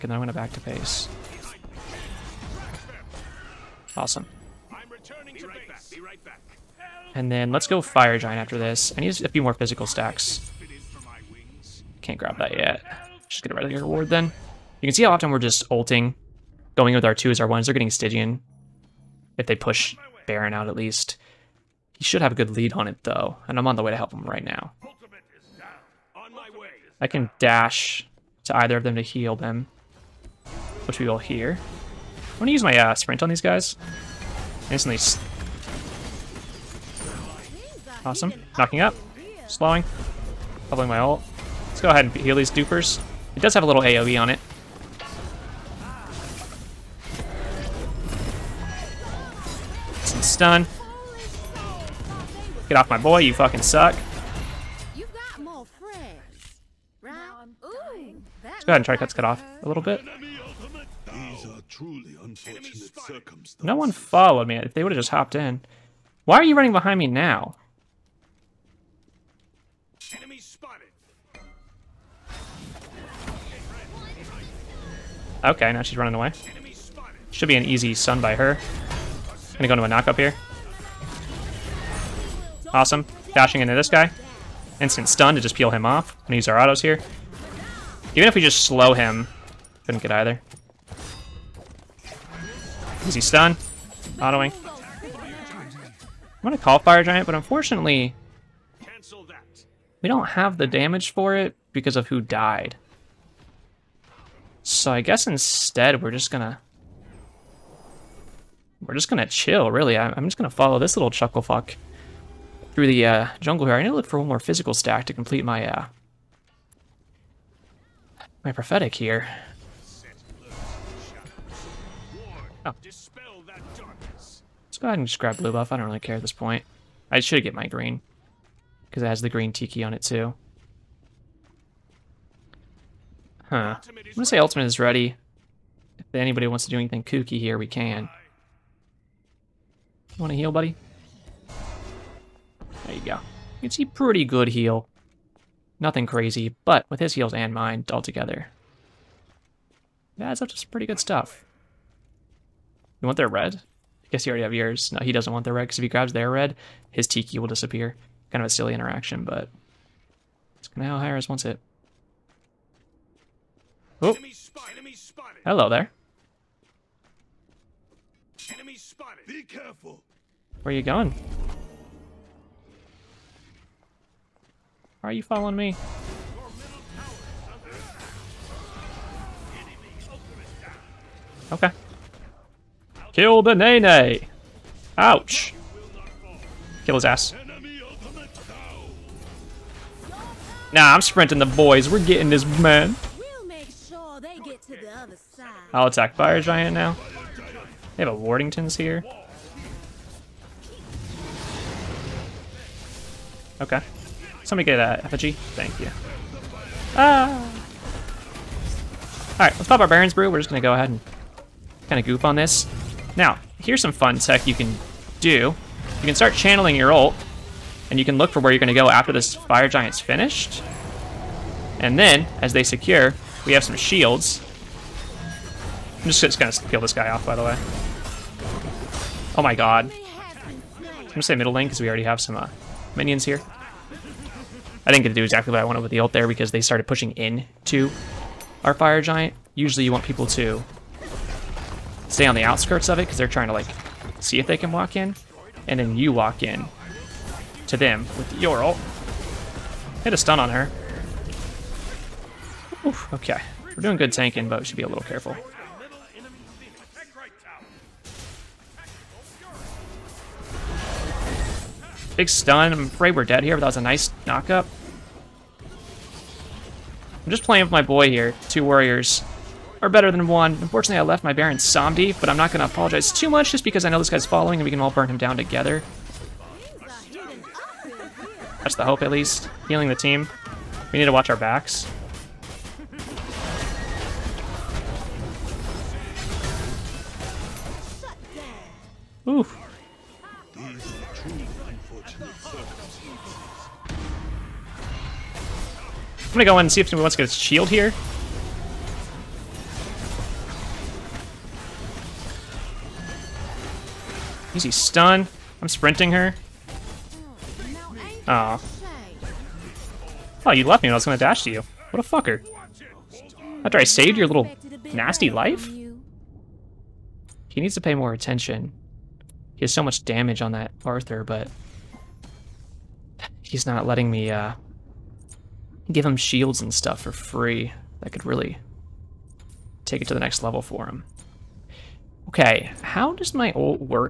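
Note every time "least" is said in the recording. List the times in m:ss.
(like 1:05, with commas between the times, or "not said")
0:20, 4:39.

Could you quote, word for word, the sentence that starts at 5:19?
He has so much damage on that Arthur, but he's not letting me uh, give him shields and stuff for free.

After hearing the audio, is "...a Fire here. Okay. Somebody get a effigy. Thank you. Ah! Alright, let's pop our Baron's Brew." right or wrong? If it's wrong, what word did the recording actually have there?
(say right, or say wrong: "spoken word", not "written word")
wrong: "Wardingtons", not "Fire".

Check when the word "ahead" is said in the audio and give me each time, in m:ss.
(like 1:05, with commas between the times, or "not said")
0:41, 0:58, 2:04, 3:30.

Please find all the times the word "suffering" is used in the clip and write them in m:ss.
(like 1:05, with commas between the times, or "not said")
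not said.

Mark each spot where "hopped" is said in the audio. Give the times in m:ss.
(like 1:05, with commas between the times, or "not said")
1:05.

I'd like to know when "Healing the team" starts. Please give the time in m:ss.
4:39.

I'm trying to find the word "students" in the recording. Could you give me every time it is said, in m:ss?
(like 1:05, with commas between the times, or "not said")
not said.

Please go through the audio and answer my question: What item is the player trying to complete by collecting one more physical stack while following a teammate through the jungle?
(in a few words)
Prophetic.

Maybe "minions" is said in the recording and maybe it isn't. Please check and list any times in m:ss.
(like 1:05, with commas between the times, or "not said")
3:52.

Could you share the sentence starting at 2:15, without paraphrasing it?
If anybody wants to do anything kooky here, we can.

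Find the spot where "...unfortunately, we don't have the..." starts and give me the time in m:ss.
1:37.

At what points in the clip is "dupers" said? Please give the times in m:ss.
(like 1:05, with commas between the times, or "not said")
0:42.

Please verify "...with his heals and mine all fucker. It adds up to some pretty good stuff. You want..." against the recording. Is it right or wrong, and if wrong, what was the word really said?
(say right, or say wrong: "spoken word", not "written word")
wrong: "together", not "fucker".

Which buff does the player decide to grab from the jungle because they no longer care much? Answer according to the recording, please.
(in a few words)
Blue buff.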